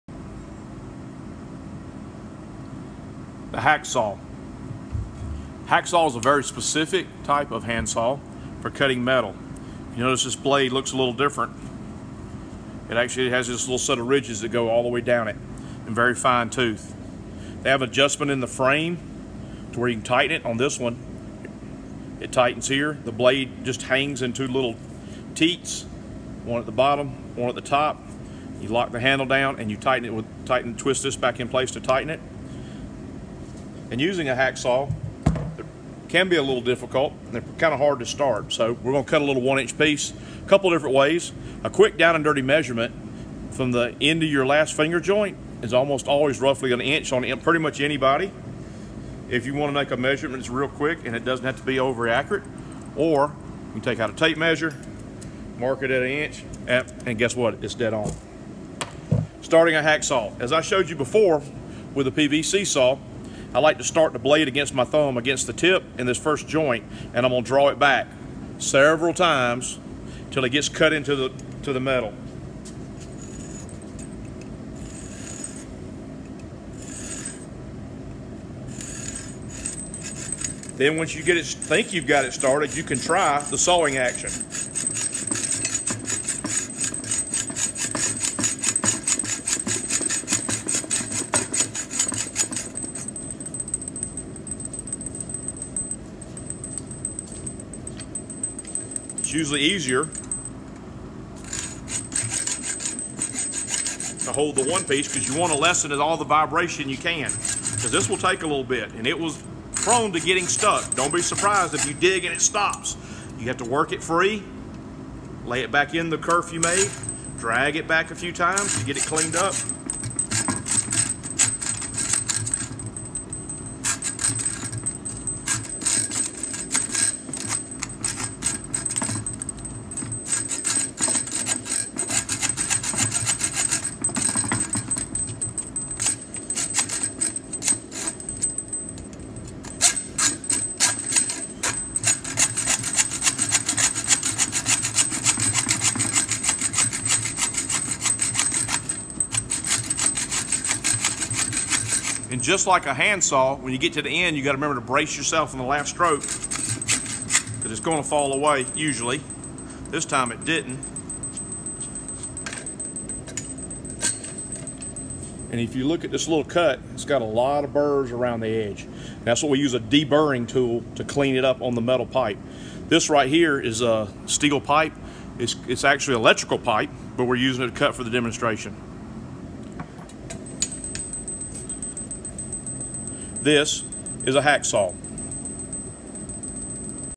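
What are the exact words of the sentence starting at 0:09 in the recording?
You notice this blade looks a little different.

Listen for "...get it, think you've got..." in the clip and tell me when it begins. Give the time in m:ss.
1:21.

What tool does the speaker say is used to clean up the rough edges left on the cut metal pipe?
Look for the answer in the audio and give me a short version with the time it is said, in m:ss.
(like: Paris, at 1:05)
deburring tool, at 2:49.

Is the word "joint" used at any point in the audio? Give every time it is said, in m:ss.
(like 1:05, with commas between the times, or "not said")
0:45, 1:06.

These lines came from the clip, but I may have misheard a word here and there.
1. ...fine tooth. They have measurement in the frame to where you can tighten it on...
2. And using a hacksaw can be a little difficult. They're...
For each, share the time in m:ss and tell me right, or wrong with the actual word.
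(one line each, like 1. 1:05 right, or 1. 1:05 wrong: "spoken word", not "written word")
1. 0:16 wrong: "adjustment", not "measurement"
2. 0:33 right.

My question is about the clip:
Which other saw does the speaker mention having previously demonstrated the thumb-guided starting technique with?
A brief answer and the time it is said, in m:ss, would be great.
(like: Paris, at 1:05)
PVC saw, at 1:02.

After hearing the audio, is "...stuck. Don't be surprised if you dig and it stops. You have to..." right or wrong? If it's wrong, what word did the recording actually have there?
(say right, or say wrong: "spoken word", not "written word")
right.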